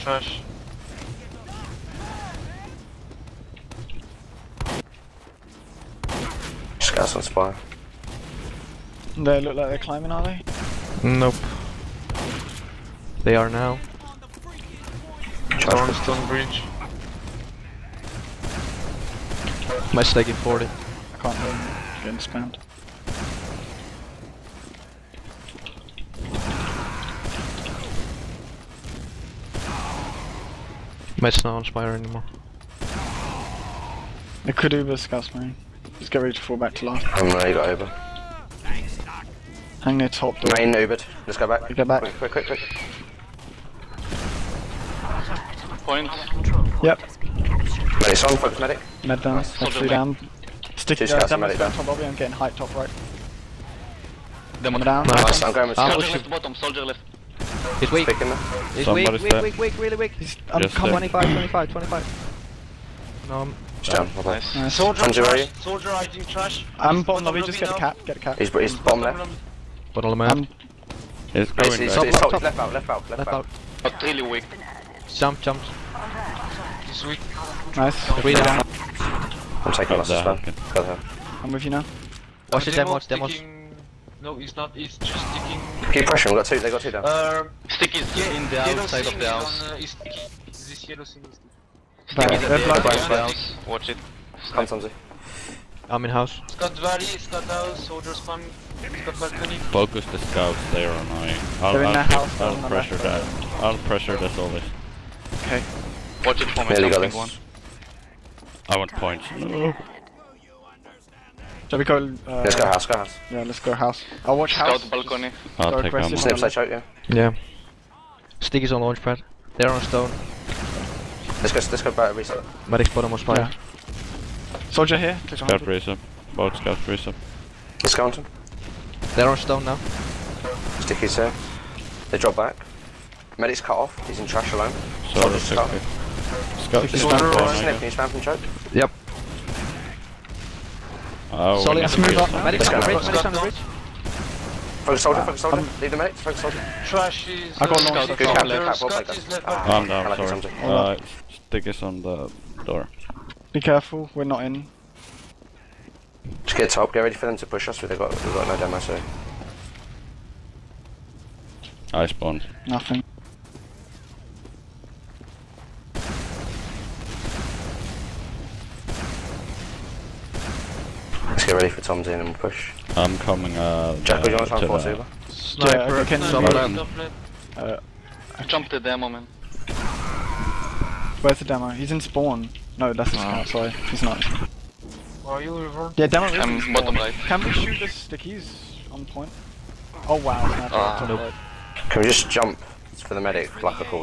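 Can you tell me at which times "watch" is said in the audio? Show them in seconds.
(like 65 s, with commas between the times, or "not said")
82 s, 93 s, 106 s, 114 s.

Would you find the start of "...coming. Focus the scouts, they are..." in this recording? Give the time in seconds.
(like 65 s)
98 s.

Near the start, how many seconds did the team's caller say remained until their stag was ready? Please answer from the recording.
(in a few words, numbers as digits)
40.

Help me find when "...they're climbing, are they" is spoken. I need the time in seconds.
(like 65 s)
9 s.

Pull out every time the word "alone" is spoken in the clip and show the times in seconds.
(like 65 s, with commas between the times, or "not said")
134 s.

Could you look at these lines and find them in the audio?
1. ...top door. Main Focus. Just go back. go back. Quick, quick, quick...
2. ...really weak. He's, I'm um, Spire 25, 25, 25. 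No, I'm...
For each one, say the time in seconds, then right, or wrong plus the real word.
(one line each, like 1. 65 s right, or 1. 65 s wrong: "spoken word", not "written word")
1. 40 s wrong: "Ubered", not "Focus"
2. 59 s wrong: "Just", not "Spire".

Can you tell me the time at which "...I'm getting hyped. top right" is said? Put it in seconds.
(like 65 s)
52 s.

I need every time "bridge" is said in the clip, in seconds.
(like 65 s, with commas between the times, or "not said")
16 s, 142 s.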